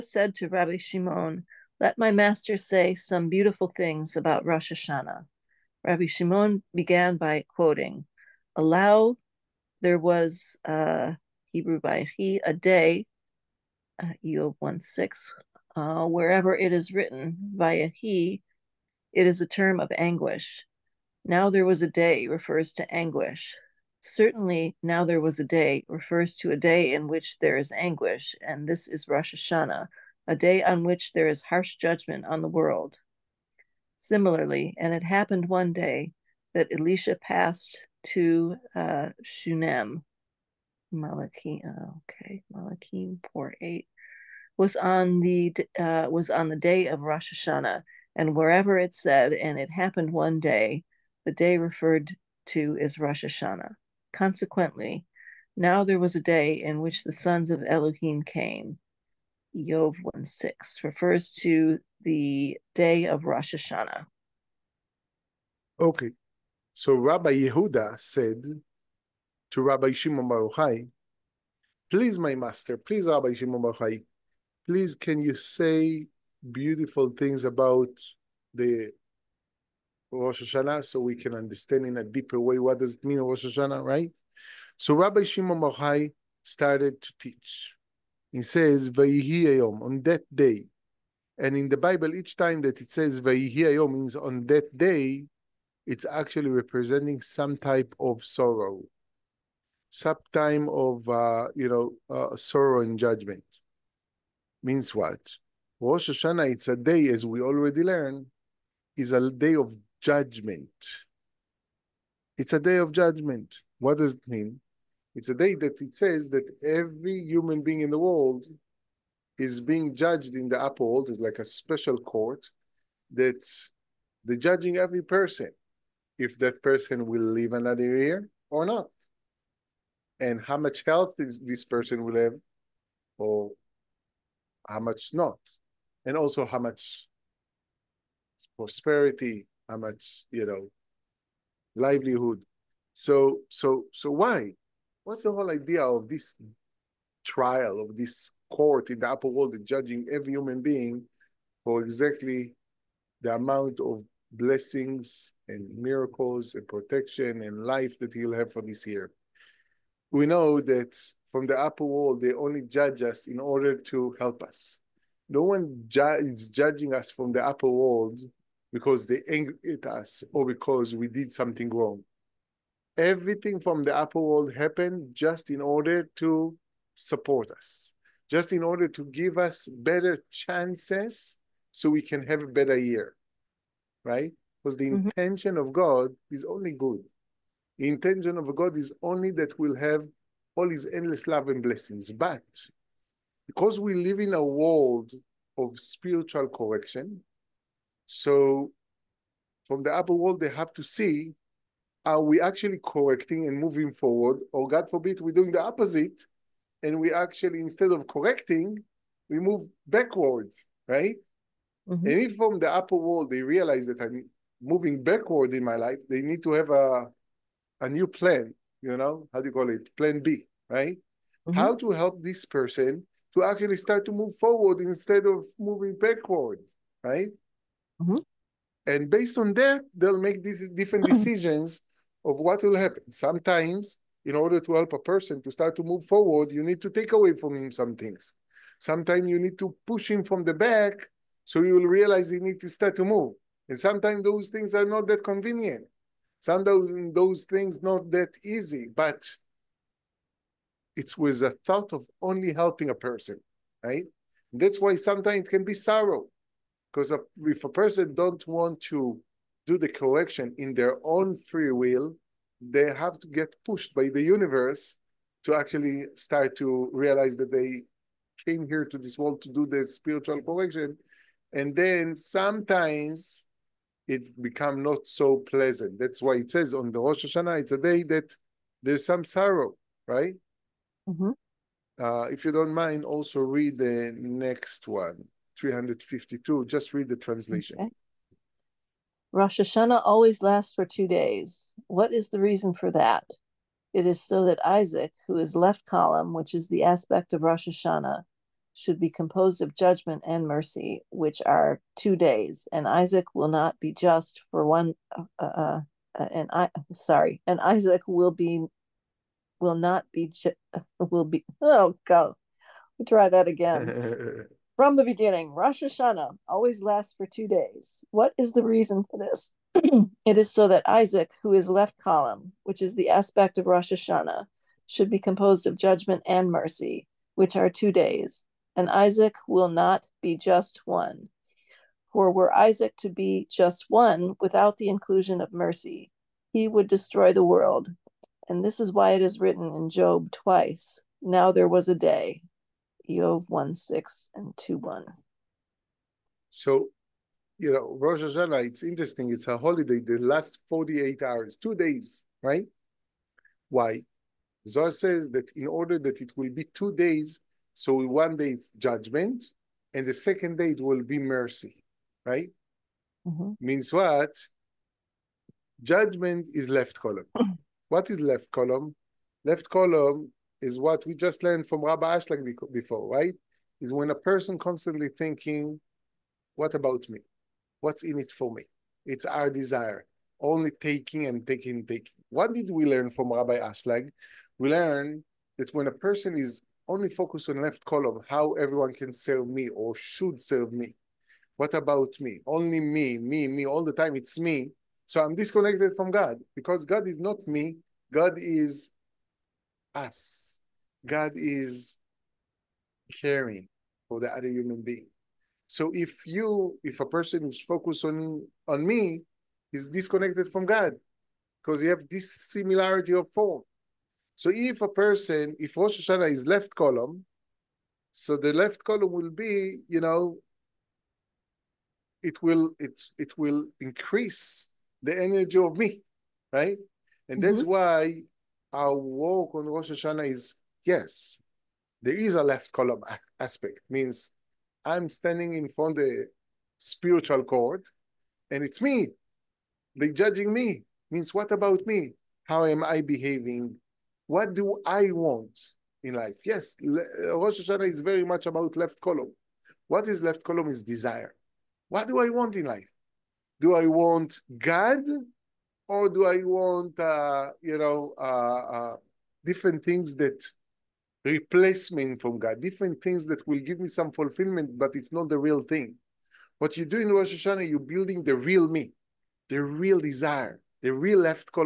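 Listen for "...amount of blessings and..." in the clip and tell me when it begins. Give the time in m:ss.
2:33.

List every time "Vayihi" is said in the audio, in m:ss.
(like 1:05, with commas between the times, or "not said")
1:28, 1:33.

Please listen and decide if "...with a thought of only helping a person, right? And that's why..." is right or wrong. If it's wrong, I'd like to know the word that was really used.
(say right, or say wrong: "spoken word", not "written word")
right.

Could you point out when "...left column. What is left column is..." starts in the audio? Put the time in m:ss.
7:28.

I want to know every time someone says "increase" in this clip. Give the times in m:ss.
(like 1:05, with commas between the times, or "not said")
7:03.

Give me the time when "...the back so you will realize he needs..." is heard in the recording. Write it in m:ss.
4:00.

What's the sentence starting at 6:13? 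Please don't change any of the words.
Is when a person constantly thinking, what about me?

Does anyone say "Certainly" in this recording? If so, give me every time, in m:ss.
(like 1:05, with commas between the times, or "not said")
0:23.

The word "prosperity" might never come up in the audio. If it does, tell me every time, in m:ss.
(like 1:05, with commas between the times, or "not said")
2:18.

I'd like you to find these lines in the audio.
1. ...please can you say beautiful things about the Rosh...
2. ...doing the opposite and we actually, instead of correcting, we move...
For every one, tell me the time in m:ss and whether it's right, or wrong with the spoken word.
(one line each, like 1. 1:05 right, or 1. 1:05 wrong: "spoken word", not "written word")
1. 1:14 right
2. 3:25 right.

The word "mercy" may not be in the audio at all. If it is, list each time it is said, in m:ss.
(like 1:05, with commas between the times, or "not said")
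5:00, 5:26, 5:35, 6:01.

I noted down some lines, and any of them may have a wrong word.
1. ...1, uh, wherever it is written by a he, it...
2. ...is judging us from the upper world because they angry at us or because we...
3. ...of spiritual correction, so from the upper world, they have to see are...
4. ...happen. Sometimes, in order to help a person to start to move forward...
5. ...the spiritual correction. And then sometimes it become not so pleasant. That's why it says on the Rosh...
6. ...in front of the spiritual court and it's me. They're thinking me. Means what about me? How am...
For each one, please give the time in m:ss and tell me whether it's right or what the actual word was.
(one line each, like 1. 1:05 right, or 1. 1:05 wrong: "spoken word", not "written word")
1. 0:14 wrong: "6", not "1"
2. 2:46 right
3. 3:15 right
4. 3:52 right
5. 4:29 right
6. 7:15 wrong: "judging", not "thinking".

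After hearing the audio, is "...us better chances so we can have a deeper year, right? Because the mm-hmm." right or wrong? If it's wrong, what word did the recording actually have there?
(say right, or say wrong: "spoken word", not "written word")
wrong: "better", not "deeper".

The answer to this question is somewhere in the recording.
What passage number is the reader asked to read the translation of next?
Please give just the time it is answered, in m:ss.
4:45.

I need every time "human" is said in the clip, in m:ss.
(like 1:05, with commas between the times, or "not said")
1:57, 2:30, 6:44.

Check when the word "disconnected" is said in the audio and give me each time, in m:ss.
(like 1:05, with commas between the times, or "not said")
6:35, 6:49.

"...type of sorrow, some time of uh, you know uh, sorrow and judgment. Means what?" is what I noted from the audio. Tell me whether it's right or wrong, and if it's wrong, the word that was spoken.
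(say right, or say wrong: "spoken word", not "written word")
right.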